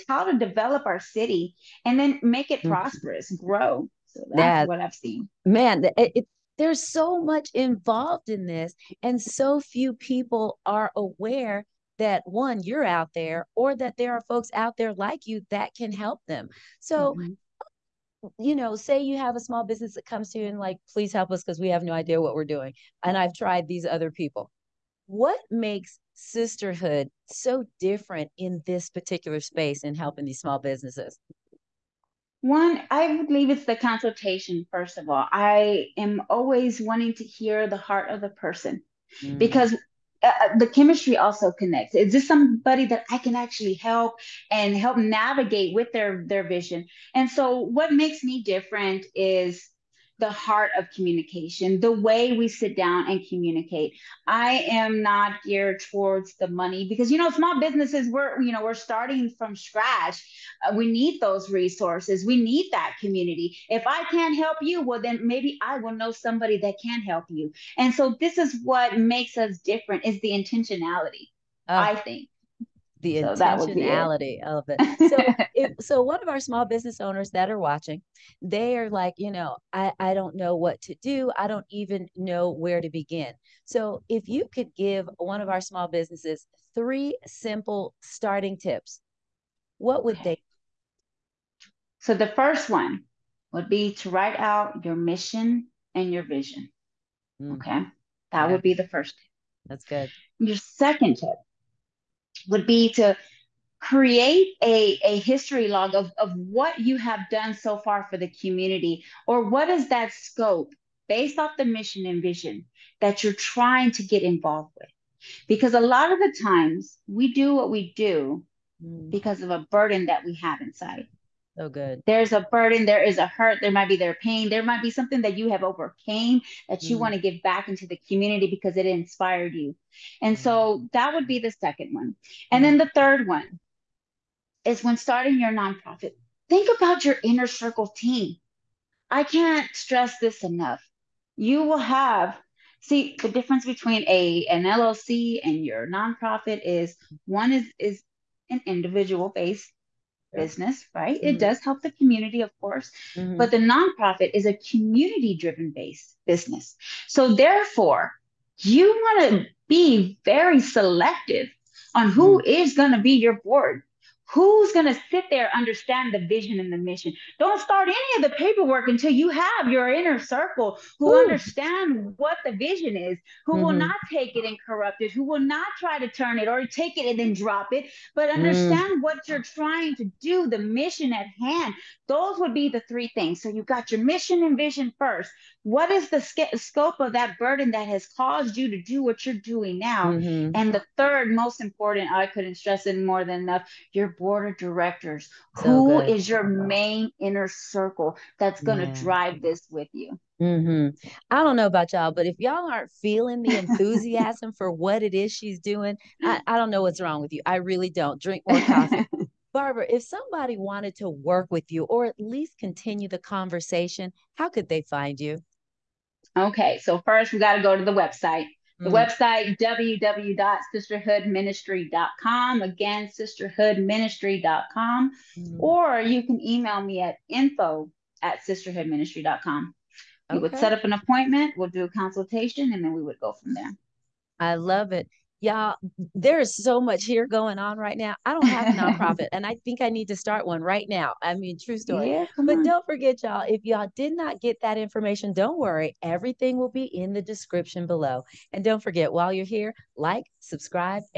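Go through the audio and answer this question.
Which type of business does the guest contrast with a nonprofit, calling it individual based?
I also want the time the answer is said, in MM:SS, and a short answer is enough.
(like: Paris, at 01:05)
LLC, at 02:24.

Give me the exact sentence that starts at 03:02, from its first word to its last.
Those would be the three things.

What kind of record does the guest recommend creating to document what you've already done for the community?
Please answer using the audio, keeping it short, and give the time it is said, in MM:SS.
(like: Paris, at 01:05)
History log, at 01:45.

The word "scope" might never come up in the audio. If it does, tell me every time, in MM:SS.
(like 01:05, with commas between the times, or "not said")
01:50, 03:06.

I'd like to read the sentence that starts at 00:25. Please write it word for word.
What makes sisterhood so different in this particular space in helping these small businesses?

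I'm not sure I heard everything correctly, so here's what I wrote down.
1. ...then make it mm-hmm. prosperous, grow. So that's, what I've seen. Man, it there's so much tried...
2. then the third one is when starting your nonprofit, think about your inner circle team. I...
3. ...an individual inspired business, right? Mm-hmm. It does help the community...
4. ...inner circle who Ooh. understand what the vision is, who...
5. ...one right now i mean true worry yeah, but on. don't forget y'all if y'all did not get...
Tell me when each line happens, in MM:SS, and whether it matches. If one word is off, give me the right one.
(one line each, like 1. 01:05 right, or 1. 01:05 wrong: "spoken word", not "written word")
1. 00:01 wrong: "involved", not "tried"
2. 02:12 right
3. 02:28 wrong: "based", not "inspired"
4. 02:49 right
5. 04:00 wrong: "story", not "worry".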